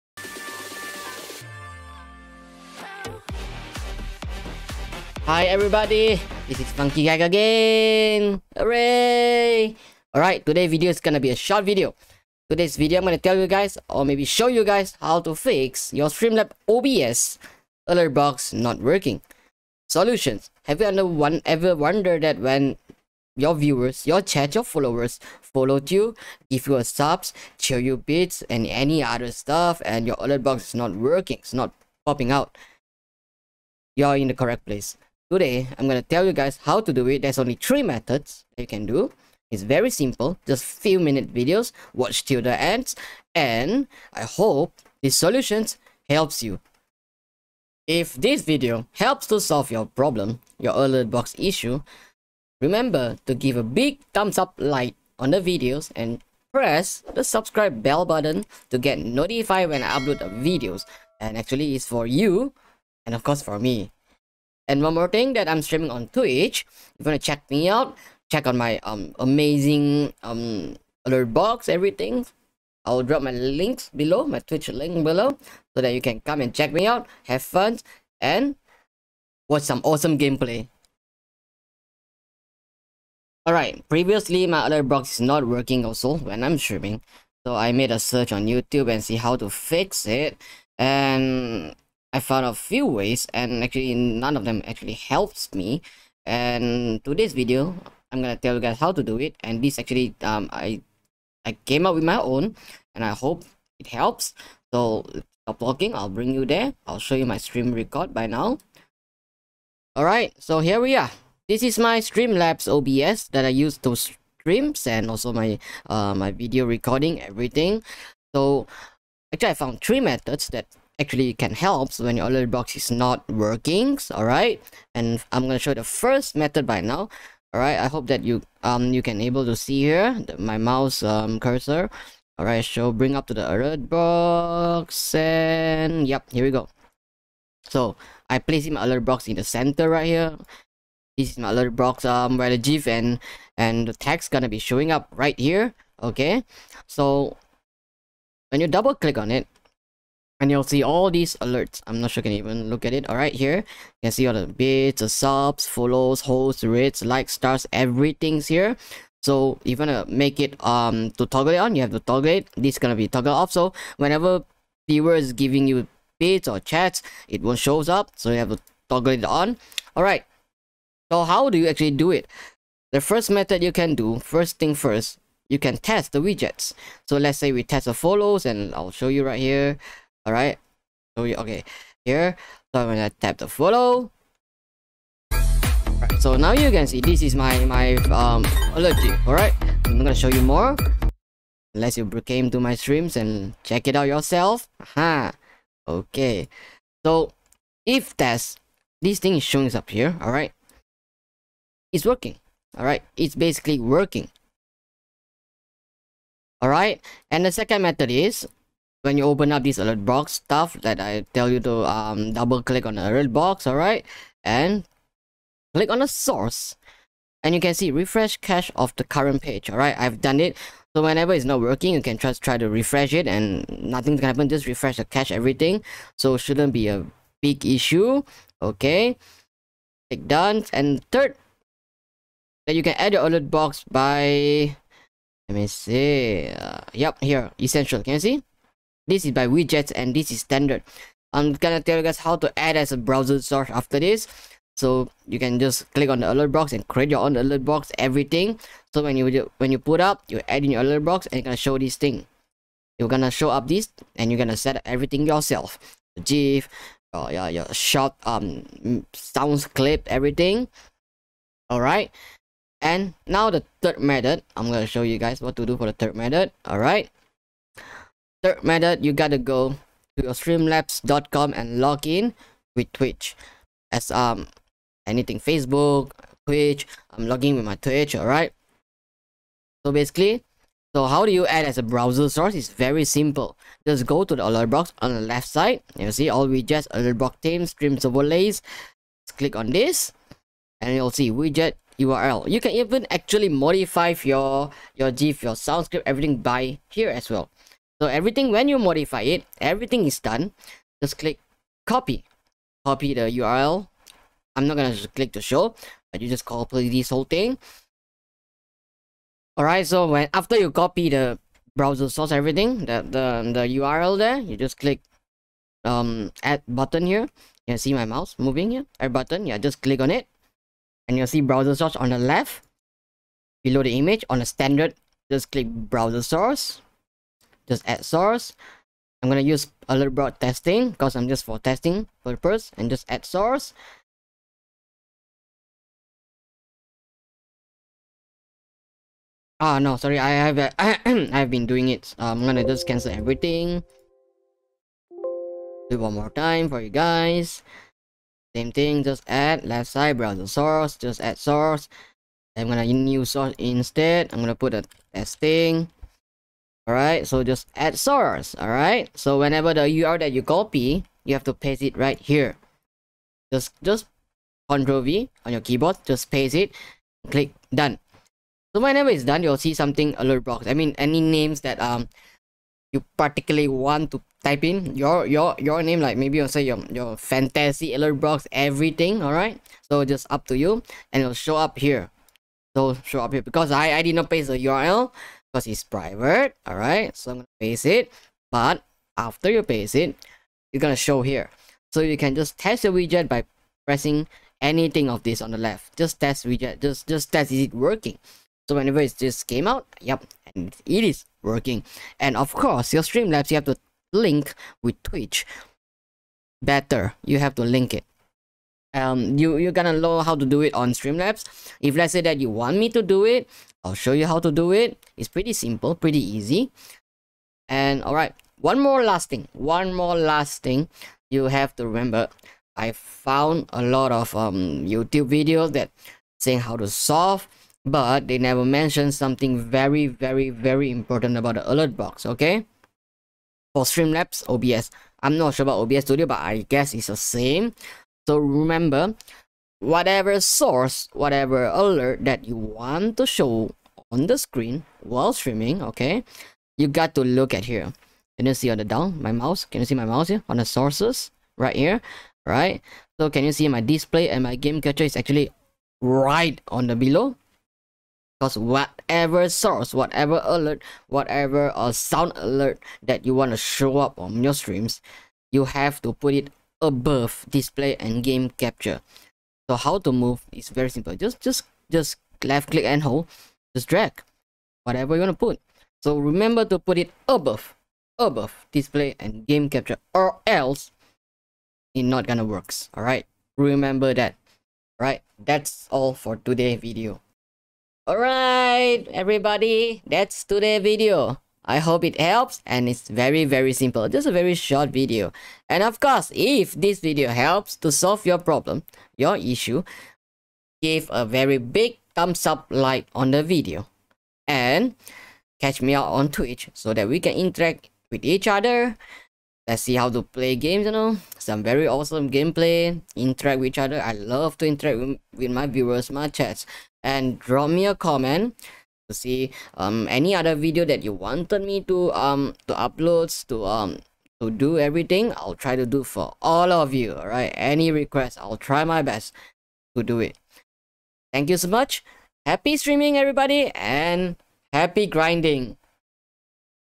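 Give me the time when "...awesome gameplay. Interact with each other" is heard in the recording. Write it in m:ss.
8:31.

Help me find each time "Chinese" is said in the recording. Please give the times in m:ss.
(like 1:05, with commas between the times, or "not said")
not said.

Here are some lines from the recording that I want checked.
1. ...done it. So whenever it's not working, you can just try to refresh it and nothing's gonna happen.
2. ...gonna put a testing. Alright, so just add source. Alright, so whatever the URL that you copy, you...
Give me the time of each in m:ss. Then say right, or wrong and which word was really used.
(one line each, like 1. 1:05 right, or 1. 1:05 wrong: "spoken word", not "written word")
1. 3:40 right
2. 5:54 wrong: "whenever", not "whatever".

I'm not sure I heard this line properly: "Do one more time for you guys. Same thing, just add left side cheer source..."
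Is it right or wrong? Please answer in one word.
wrong.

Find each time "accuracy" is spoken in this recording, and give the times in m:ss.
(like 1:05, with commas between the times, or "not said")
not said.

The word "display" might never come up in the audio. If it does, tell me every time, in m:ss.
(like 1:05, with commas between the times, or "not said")
7:33, 7:47, 7:58.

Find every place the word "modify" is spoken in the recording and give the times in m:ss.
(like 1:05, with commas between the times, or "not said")
4:53, 4:58.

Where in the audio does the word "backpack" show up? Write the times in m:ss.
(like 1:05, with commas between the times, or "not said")
not said.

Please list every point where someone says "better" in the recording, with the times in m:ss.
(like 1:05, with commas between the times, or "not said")
6:46.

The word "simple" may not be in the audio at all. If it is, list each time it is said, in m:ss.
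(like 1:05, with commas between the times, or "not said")
0:39, 4:43, 6:55, 7:50, 8:13.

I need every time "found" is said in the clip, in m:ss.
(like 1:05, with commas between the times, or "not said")
1:32, 1:59, 7:02.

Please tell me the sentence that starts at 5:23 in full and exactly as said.
Below the image, on the standard, just click browser source just add source.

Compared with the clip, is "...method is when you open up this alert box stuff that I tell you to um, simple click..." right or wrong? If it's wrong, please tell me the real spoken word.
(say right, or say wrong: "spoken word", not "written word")
wrong: "double", not "simple".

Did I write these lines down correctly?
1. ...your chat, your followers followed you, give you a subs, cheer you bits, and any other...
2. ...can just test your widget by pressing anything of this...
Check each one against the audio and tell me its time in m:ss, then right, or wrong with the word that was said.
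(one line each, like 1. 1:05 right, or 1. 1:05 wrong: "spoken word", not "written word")
1. 0:24 right
2. 6:32 right.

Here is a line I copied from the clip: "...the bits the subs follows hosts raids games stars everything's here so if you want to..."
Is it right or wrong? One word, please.
wrong.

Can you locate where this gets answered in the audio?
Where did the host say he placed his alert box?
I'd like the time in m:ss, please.
2:19.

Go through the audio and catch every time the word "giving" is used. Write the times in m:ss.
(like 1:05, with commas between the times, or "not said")
2:45.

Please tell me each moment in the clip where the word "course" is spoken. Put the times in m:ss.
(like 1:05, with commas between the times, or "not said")
1:03, 6:42, 8:15.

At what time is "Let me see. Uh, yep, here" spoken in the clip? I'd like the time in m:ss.
3:55.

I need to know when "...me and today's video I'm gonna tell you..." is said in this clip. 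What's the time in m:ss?
1:35.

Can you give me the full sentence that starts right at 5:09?
Alright, so when after you copy the browser source, everything, the, the, the URL there, you just click um add button here.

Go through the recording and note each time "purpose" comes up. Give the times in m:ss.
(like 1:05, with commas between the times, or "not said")
5:32.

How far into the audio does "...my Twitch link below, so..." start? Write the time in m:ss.
1:14.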